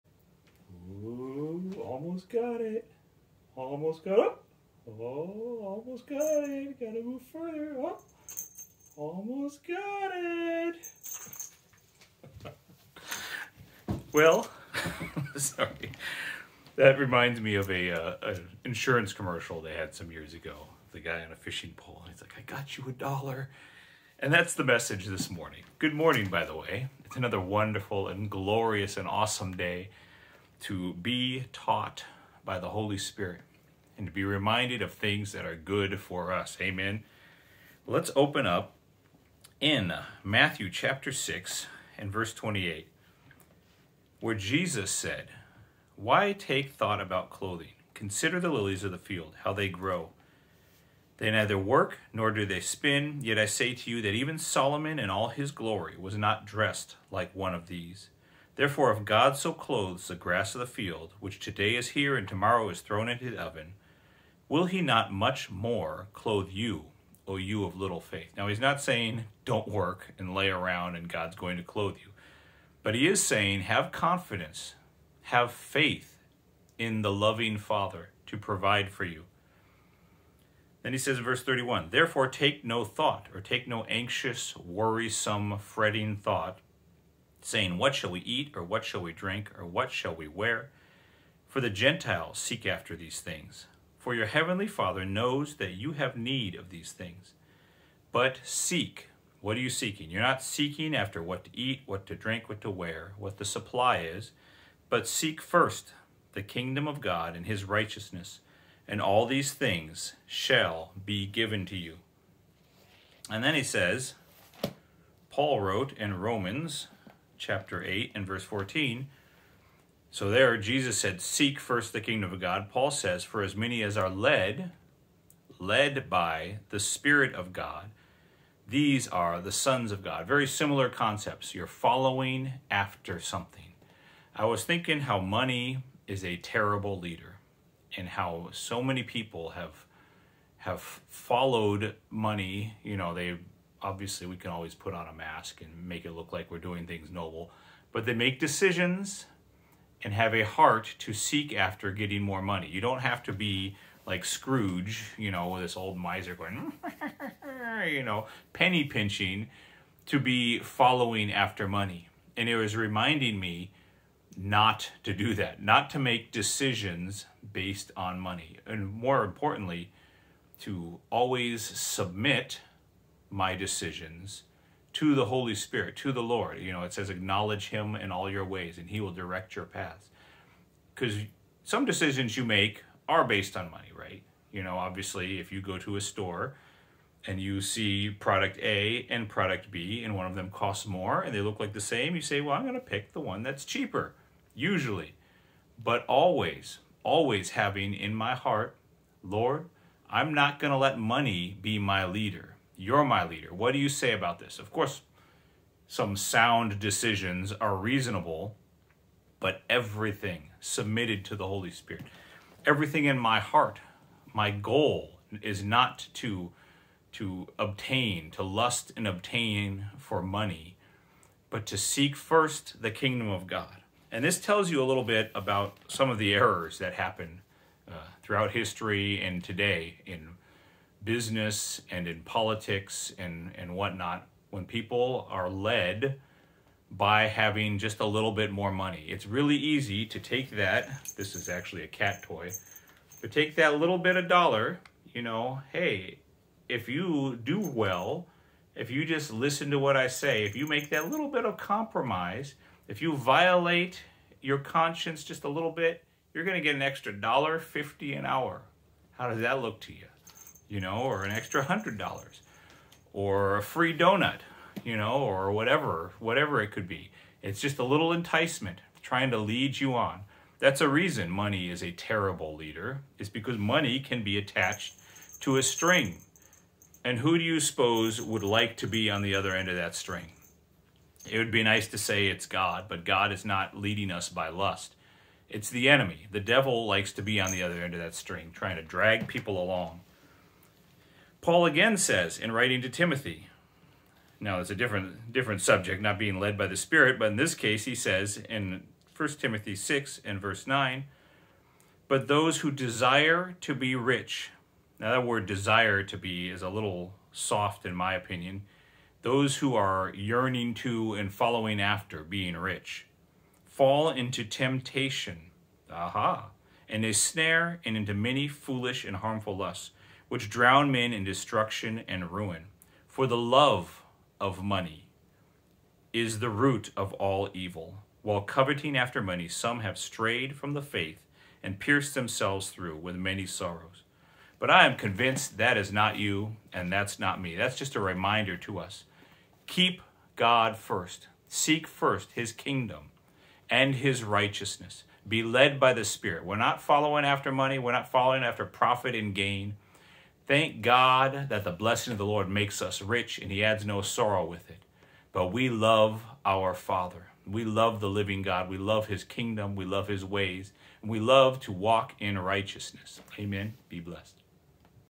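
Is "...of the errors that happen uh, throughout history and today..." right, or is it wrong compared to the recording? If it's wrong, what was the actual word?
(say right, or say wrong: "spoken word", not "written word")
right.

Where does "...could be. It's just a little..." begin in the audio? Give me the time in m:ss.
4:26.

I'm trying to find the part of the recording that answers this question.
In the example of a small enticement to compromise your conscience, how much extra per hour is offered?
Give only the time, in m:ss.
4:17.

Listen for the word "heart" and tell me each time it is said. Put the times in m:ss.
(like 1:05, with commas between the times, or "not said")
2:30, 3:18, 3:33.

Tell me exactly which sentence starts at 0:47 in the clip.
Consider the lilies of the field, how they grow.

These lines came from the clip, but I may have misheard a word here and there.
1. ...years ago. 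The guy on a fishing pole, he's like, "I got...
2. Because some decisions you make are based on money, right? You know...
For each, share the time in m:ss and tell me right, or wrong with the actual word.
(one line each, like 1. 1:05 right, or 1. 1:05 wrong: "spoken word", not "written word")
1. 0:20 right
2. 3:00 right.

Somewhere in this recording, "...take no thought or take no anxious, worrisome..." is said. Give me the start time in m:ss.
1:22.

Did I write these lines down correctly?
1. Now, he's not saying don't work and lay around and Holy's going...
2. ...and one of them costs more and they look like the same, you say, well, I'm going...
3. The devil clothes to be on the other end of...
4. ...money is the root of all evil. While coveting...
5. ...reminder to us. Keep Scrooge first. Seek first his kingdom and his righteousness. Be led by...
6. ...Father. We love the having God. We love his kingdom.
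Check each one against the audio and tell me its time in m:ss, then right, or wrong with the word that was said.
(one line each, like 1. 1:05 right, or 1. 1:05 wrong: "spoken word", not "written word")
1. 1:08 wrong: "God", not "Holy"
2. 3:10 right
3. 4:46 wrong: "likes", not "clothes"
4. 5:24 right
5. 5:37 wrong: "God", not "Scrooge"
6. 5:56 wrong: "living", not "having".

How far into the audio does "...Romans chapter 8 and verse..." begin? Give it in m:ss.
1:56.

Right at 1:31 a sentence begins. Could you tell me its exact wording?
For the Gentiles seek after these things.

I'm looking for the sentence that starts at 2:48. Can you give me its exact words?
And more importantly, to always submit my decisions to the Holy Spirit, to the Lord.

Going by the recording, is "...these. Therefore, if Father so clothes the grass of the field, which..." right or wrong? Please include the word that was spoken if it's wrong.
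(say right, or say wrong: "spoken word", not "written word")
wrong: "God", not "Father".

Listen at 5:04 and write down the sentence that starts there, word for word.
Now that word desire to be is a little soft in my opinion.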